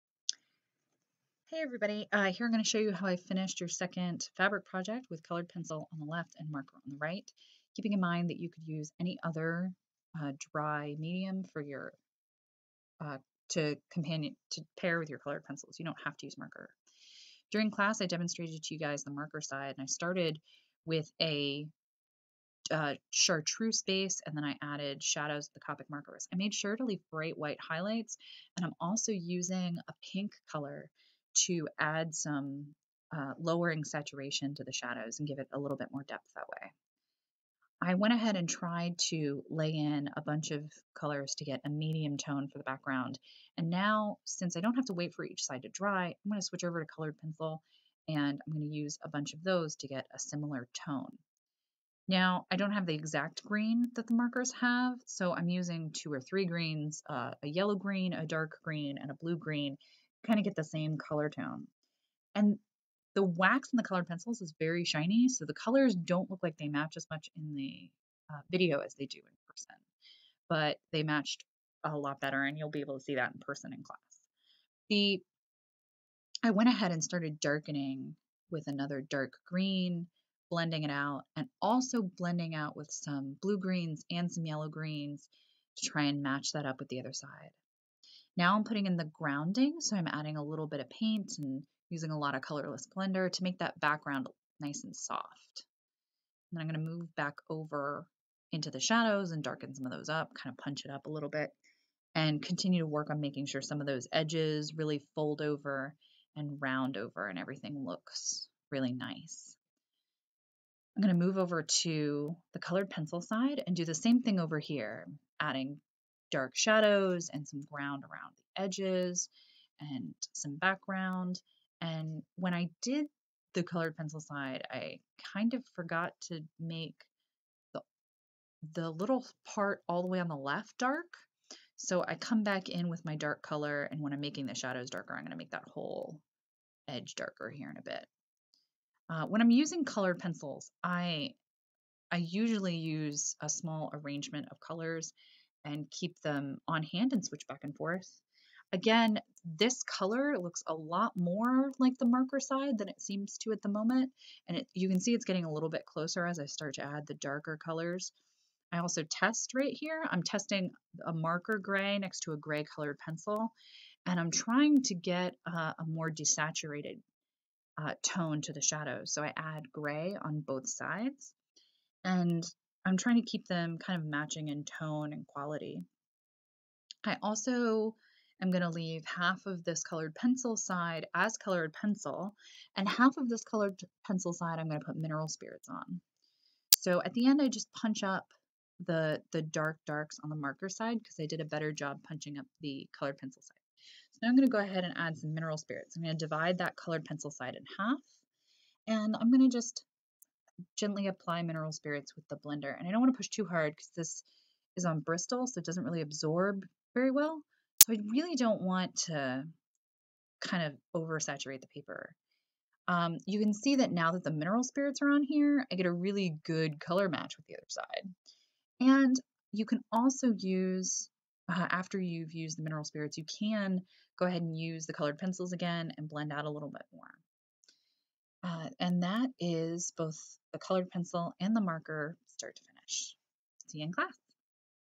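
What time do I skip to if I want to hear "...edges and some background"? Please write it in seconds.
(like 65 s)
118 s.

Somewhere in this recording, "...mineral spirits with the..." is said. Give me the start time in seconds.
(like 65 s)
201 s.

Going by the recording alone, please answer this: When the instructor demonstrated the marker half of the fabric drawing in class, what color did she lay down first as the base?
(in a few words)
Chartreuse.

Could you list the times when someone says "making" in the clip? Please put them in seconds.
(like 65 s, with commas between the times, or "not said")
103 s, 134 s.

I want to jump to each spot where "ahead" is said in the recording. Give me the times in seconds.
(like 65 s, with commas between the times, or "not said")
38 s, 76 s, 194 s, 224 s.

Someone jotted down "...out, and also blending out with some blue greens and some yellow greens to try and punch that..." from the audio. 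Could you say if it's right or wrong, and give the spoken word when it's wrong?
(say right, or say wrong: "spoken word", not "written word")
wrong: "match", not "punch".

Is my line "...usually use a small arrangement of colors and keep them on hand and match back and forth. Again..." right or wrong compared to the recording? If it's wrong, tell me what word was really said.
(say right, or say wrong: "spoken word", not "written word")
wrong: "switch", not "match".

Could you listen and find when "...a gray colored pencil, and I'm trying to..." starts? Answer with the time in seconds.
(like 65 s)
162 s.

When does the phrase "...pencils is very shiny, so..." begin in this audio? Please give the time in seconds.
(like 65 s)
64 s.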